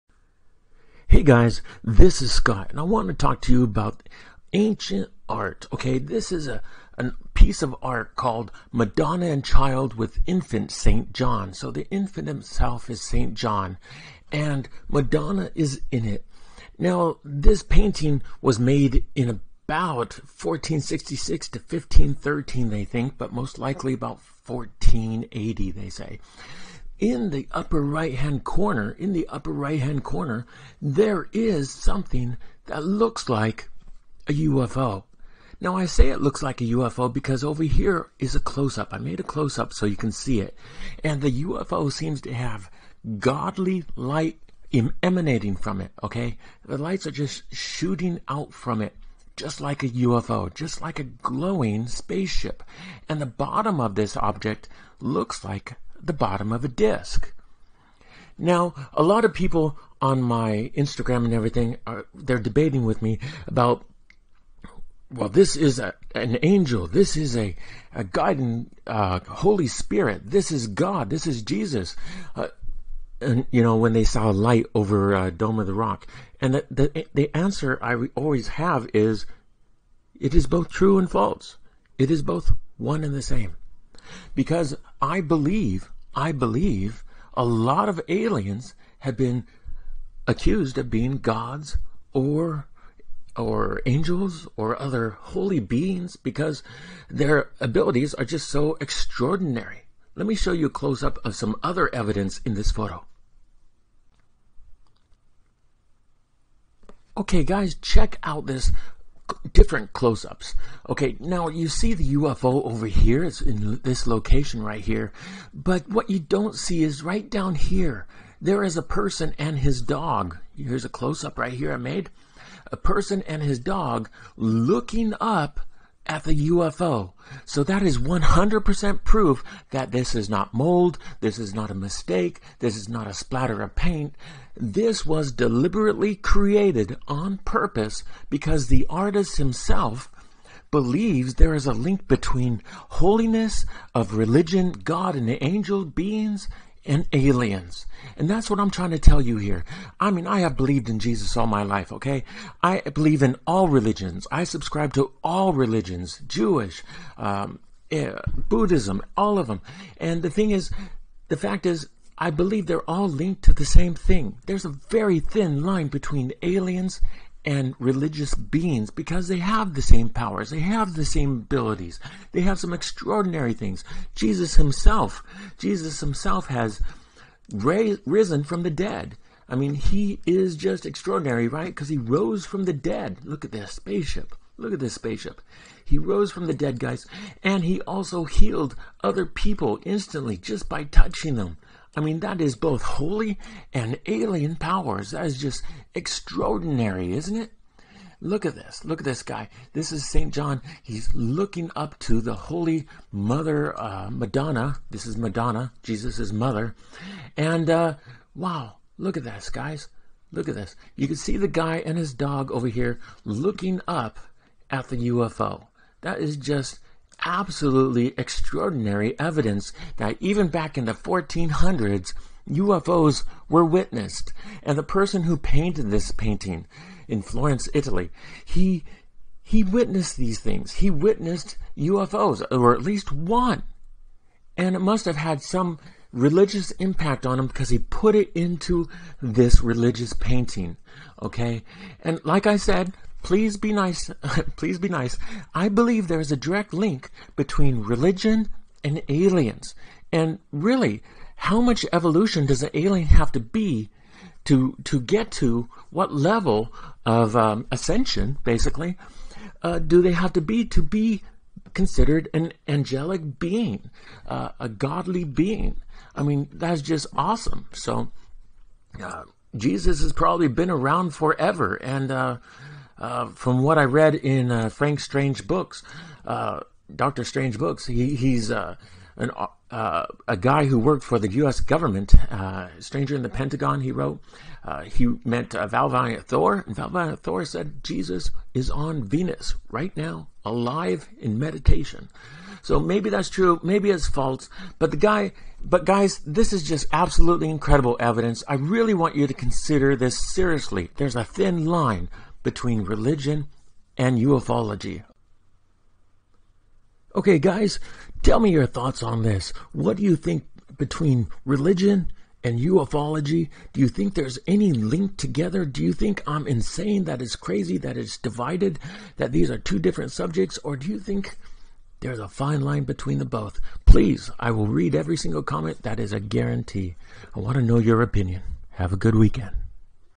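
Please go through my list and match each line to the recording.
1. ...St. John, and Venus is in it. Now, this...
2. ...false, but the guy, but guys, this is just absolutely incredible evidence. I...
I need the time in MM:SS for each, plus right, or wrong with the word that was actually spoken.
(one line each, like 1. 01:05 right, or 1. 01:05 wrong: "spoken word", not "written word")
1. 00:13 wrong: "Madonna", not "Venus"
2. 04:54 right.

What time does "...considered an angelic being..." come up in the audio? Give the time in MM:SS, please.
04:21.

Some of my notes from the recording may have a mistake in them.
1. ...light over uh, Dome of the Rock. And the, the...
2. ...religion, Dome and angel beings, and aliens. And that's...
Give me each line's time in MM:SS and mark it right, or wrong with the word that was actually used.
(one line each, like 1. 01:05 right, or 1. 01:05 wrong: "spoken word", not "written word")
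1. 01:14 right
2. 02:24 wrong: "God", not "Dome".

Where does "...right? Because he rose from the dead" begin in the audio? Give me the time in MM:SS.
03:01.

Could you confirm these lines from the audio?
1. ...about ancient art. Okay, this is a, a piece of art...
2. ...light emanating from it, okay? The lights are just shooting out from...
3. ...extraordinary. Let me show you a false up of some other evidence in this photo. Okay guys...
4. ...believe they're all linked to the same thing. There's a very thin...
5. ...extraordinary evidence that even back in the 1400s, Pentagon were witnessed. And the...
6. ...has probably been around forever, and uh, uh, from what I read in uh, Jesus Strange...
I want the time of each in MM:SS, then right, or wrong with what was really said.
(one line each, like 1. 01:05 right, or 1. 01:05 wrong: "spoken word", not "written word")
1. 00:03 right
2. 00:43 right
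3. 01:38 wrong: "close", not "false"
4. 02:42 right
5. 03:38 wrong: "UFOs", not "Pentagon"
6. 04:30 wrong: "Frank", not "Jesus".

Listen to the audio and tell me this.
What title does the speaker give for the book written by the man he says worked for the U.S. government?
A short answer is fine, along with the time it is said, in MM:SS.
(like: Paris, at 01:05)
Stranger in the Pentagon, at 04:42.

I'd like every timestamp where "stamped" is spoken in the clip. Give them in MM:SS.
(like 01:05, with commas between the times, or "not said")
not said.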